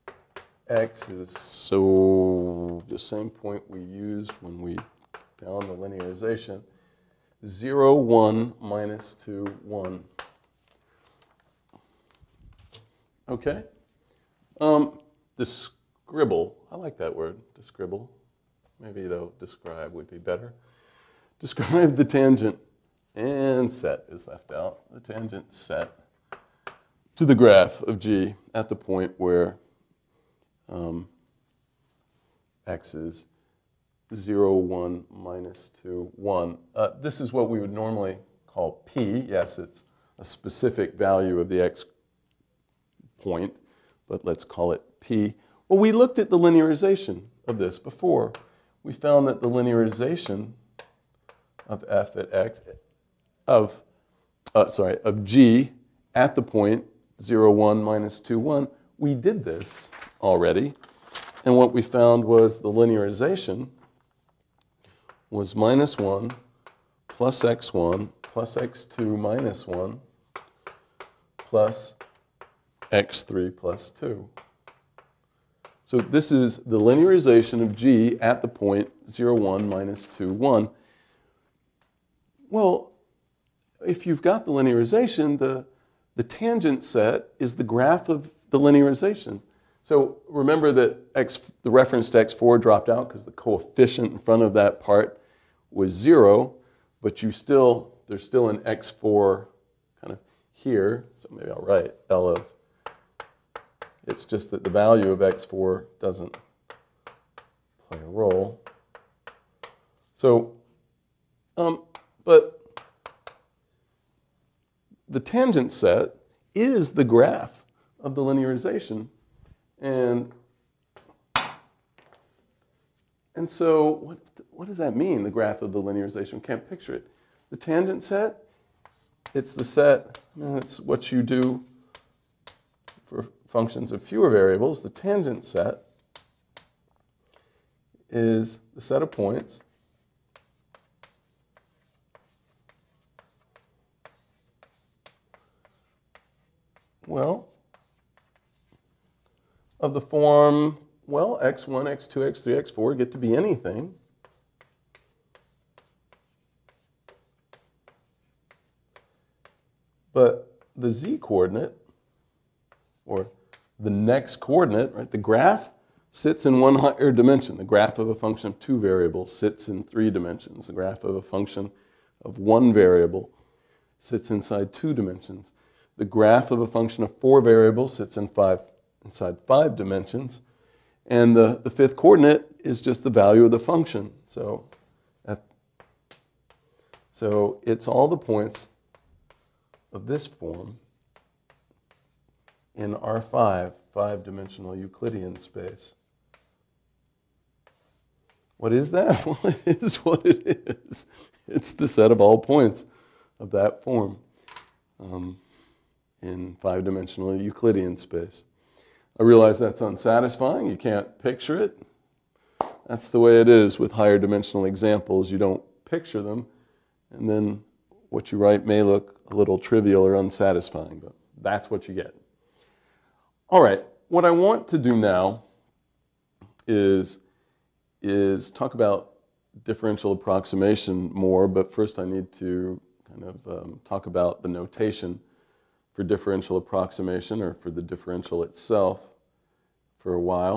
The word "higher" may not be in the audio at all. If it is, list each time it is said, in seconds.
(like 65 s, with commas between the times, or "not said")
166 s, 213 s.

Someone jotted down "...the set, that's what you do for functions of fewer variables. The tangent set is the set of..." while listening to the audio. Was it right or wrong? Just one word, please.
right.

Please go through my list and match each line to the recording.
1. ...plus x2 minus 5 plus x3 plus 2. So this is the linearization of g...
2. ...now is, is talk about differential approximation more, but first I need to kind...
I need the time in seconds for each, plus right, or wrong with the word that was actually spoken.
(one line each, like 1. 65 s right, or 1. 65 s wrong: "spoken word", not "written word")
1. 68 s wrong: "1", not "5"
2. 224 s right.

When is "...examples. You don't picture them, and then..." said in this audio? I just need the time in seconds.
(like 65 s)
214 s.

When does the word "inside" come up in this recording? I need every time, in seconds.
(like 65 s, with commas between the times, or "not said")
174 s, 179 s.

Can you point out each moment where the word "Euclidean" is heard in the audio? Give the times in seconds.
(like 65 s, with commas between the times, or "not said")
194 s, 207 s.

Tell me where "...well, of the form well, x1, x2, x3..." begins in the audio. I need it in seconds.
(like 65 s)
147 s.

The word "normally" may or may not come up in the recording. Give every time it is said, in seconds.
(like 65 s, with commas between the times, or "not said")
37 s.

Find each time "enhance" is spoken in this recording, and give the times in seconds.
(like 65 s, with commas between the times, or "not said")
not said.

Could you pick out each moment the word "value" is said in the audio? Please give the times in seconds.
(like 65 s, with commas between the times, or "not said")
40 s, 104 s, 183 s.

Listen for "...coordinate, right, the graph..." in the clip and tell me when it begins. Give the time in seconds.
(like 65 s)
164 s.